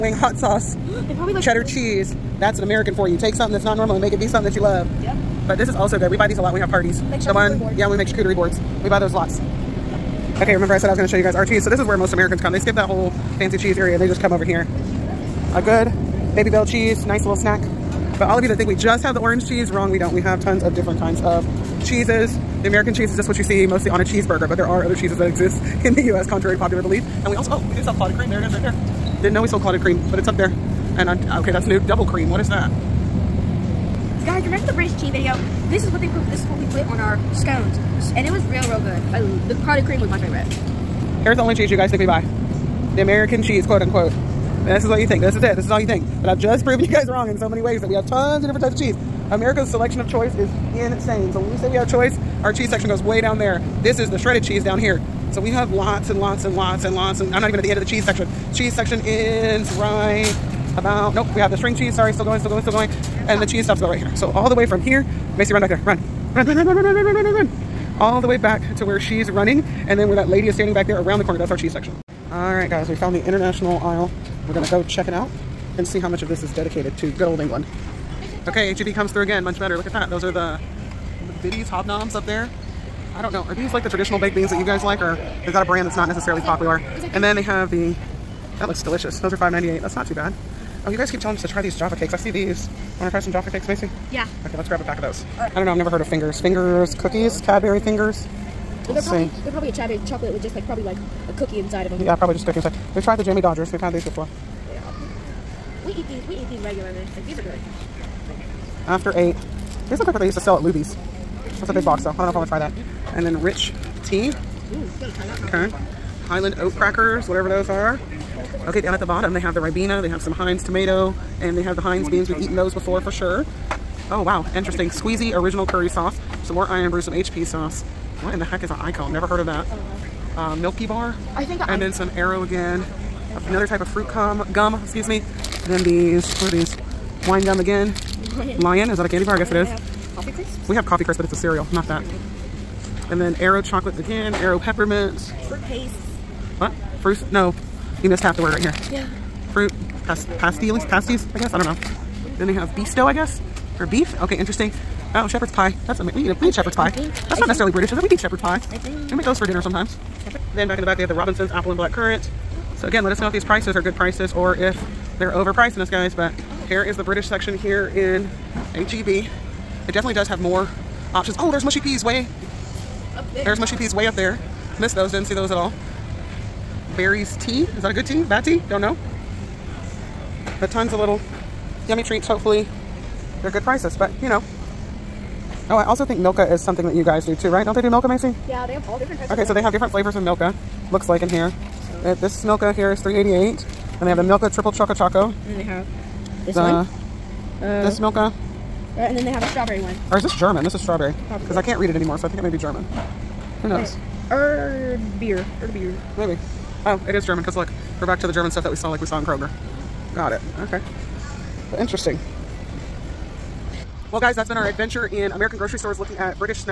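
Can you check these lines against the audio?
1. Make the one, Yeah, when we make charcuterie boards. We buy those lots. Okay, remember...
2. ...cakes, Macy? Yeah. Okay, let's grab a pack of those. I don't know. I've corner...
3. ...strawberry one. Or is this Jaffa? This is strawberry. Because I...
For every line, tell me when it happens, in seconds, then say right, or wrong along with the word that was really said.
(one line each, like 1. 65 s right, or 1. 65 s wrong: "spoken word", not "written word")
1. 7 s right
2. 93 s wrong: "never", not "corner"
3. 199 s wrong: "German", not "Jaffa".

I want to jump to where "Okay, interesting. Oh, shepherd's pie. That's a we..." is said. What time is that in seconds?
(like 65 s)
154 s.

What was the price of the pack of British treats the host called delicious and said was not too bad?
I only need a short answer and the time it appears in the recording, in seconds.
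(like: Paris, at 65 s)
$5.98, at 89 s.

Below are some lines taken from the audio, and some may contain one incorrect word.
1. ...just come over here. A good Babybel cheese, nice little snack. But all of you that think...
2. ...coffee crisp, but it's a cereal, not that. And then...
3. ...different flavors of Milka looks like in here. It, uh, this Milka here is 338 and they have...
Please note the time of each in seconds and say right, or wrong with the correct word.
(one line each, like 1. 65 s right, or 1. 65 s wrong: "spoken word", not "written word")
1. 14 s right
2. 140 s right
3. 189 s wrong: "388", not "338".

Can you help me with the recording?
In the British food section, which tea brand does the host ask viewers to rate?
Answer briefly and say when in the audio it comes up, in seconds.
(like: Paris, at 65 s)
Barry's, at 176 s.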